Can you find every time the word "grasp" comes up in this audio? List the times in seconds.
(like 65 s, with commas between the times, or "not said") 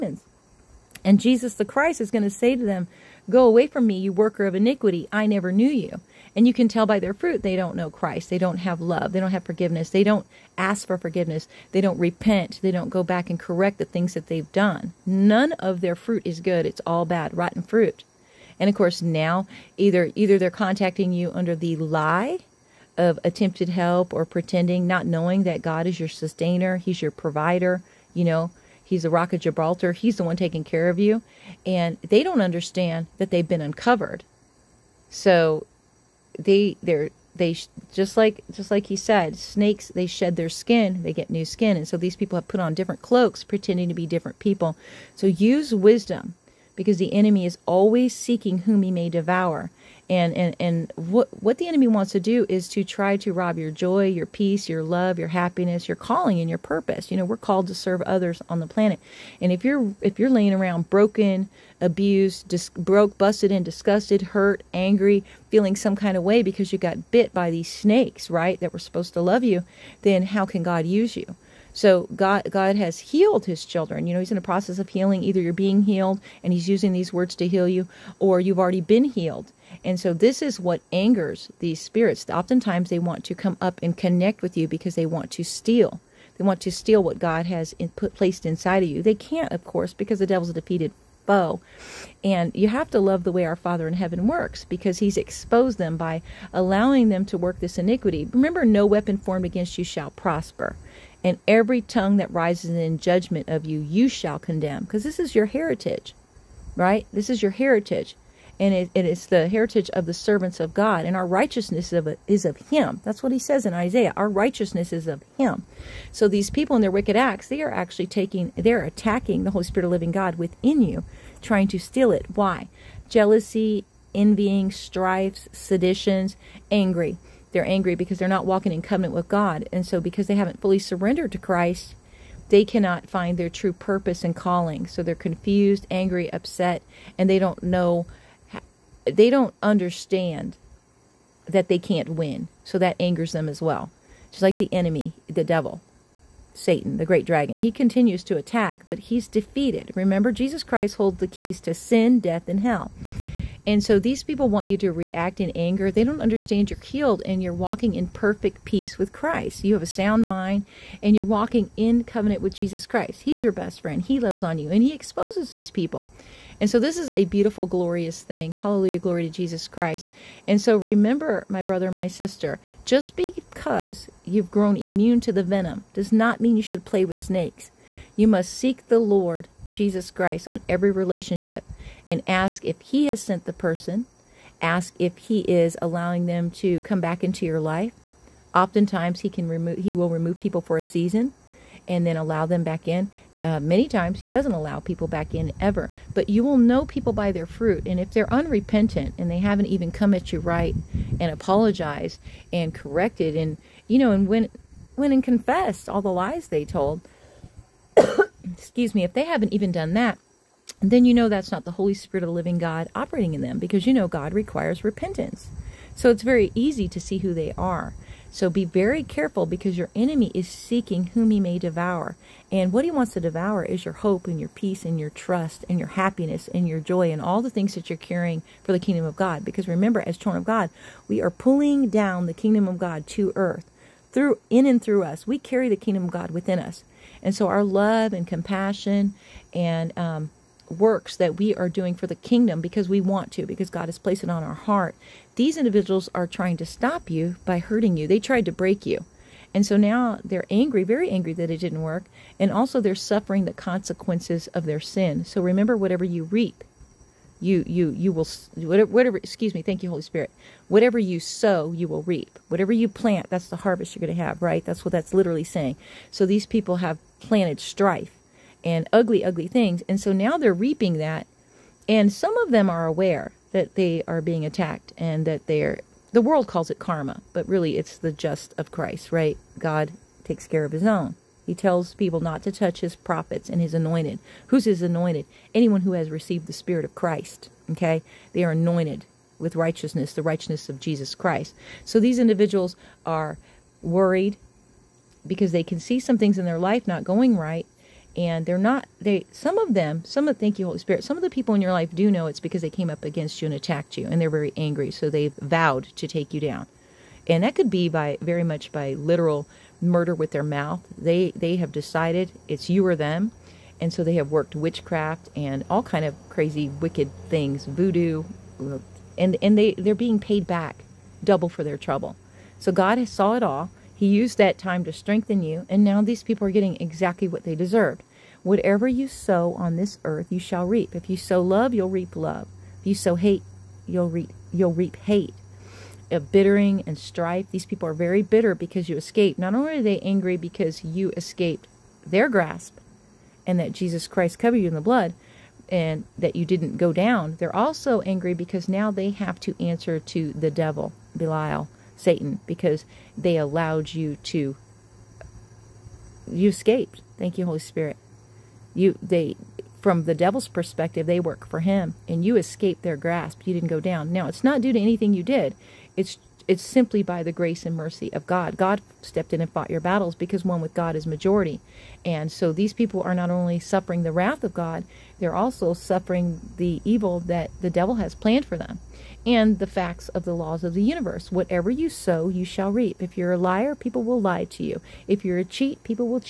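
342 s, 362 s.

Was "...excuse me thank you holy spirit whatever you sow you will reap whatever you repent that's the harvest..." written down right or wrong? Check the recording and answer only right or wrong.
wrong.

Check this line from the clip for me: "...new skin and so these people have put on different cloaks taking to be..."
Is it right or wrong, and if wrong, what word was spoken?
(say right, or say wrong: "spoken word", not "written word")
wrong: "pretending", not "taking".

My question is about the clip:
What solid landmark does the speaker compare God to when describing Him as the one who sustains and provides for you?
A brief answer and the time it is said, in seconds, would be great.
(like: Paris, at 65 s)
Rock of Gibraltar, at 29 s.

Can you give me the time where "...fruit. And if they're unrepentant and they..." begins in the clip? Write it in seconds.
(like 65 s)
197 s.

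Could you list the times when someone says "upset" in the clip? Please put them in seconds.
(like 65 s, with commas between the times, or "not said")
136 s.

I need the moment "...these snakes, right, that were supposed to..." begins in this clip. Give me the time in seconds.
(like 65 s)
67 s.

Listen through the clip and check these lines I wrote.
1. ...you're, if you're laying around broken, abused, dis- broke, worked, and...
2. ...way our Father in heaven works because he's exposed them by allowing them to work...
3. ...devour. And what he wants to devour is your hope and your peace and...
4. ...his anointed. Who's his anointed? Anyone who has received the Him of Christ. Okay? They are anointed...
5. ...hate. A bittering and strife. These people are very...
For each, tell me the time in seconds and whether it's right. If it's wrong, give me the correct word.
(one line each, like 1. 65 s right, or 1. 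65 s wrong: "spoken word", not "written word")
1. 59 s wrong: "busted", not "worked"
2. 93 s right
3. 221 s right
4. 283 s wrong: "Spirit", not "Him"
5. 334 s right.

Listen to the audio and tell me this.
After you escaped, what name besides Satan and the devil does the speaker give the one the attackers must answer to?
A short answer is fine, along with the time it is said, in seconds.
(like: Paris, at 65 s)
Belial, at 351 s.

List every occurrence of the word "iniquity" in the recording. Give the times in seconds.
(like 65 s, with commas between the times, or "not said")
4 s, 97 s.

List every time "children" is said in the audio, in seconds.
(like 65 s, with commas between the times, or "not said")
73 s, 230 s.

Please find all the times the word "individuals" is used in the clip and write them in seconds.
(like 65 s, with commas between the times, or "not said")
245 s, 292 s.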